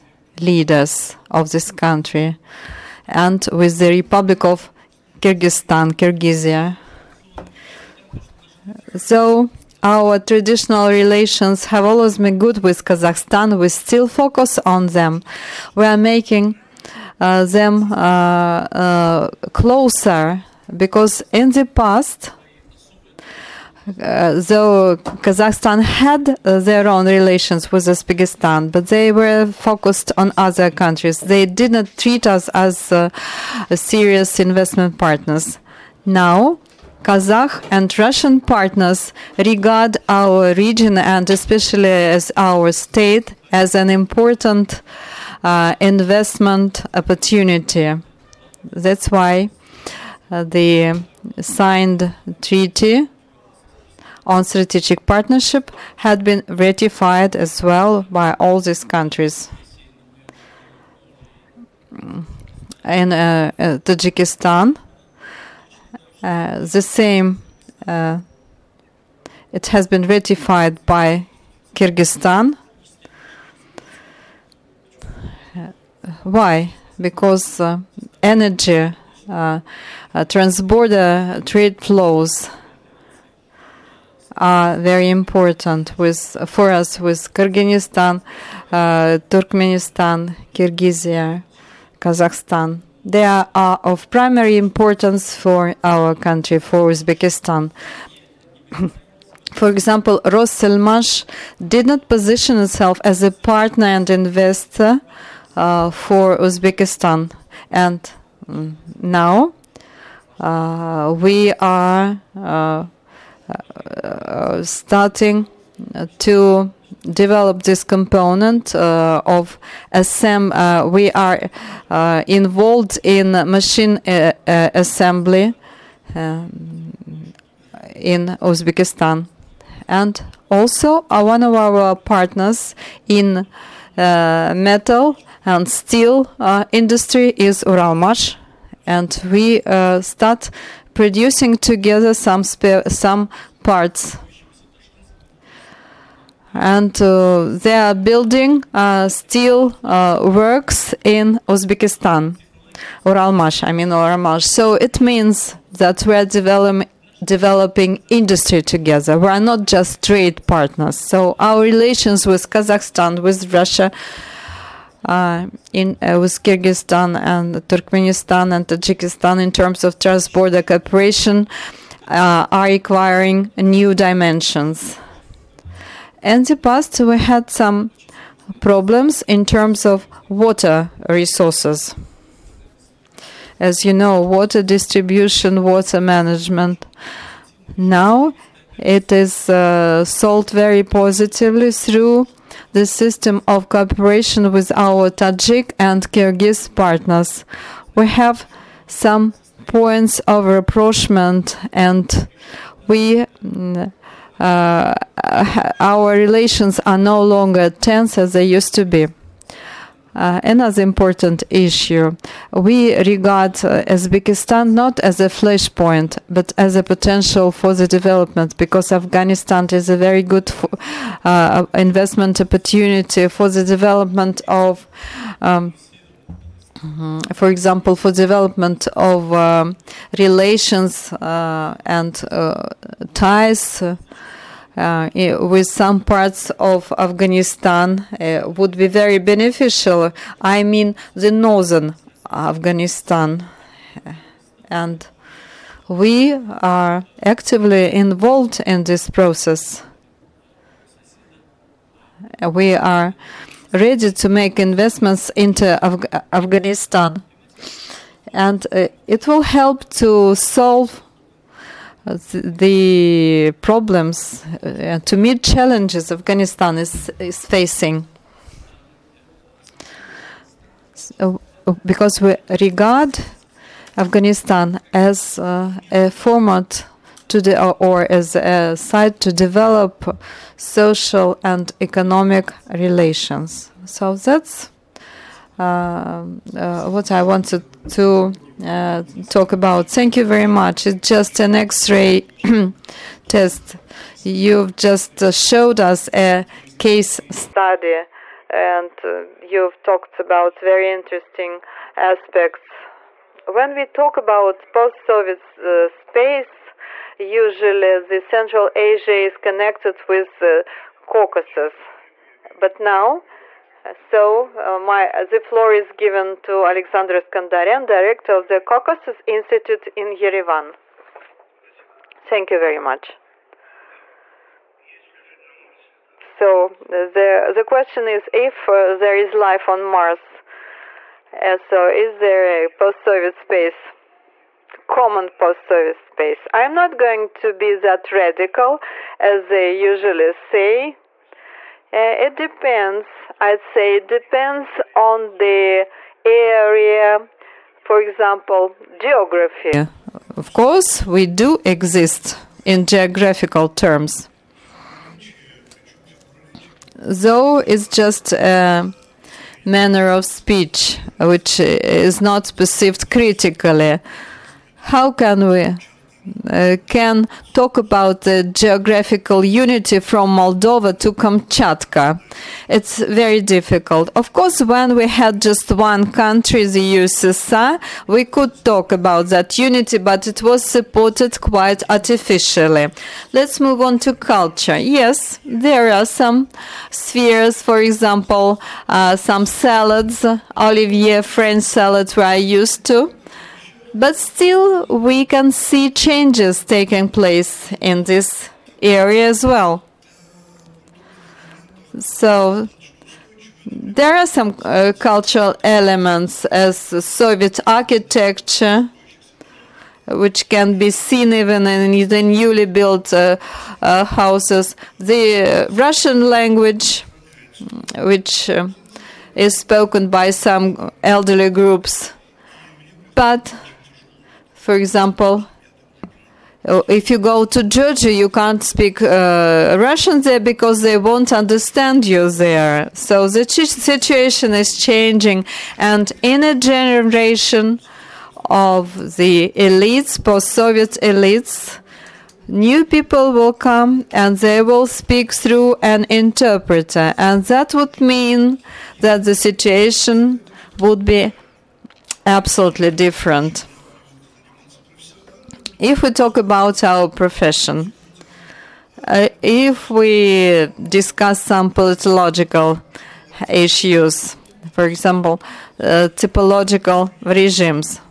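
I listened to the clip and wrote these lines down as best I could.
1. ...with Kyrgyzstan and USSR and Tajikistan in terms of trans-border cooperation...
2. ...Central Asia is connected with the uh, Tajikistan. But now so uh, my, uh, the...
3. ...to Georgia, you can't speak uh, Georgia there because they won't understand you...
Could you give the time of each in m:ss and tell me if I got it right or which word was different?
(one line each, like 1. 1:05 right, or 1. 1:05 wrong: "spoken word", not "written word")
1. 2:46 wrong: "Turkmenistan", not "USSR"
2. 5:08 wrong: "Caucasus", not "Tajikistan"
3. 7:07 wrong: "Russian", not "Georgia".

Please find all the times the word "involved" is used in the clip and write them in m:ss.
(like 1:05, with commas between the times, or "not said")
2:02, 4:07.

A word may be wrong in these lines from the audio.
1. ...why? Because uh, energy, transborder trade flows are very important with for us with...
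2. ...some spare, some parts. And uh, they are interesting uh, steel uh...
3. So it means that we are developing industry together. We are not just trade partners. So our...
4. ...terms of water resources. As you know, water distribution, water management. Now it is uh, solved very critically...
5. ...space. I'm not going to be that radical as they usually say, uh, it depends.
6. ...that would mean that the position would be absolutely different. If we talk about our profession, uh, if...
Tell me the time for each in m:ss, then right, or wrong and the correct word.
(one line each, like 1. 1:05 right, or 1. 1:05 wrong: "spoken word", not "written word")
1. 1:16 right
2. 2:22 wrong: "building", not "interesting"
3. 2:34 right
4. 2:59 wrong: "positively", not "critically"
5. 5:35 right
6. 7:27 wrong: "situation", not "position".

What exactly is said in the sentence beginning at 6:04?
How can we uh, can talk about the geographical unity from Moldova to Kamchatka.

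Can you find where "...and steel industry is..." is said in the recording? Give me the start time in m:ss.
2:15.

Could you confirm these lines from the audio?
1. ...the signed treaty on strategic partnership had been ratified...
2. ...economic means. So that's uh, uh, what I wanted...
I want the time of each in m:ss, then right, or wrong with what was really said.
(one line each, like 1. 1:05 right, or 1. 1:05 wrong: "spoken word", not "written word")
1. 0:50 right
2. 4:41 wrong: "relations", not "means".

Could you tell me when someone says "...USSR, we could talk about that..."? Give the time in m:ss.
6:16.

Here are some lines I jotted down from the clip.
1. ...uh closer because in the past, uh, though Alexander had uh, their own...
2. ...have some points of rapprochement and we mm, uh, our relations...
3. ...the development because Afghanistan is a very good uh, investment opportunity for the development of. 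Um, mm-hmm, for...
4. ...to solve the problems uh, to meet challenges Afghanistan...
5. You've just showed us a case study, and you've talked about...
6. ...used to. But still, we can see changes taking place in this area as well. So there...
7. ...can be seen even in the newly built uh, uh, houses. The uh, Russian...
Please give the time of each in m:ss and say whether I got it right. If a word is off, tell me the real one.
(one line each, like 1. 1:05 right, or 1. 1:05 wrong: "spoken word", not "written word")
1. 0:17 wrong: "Kazakhstan", not "Alexander"
2. 3:18 right
3. 3:37 right
4. 4:19 right
5. 4:54 right
6. 6:32 right
7. 6:50 right.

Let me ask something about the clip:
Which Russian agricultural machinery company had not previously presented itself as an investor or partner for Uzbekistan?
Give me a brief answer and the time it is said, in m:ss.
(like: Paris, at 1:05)
Rosselmash, at 1:40.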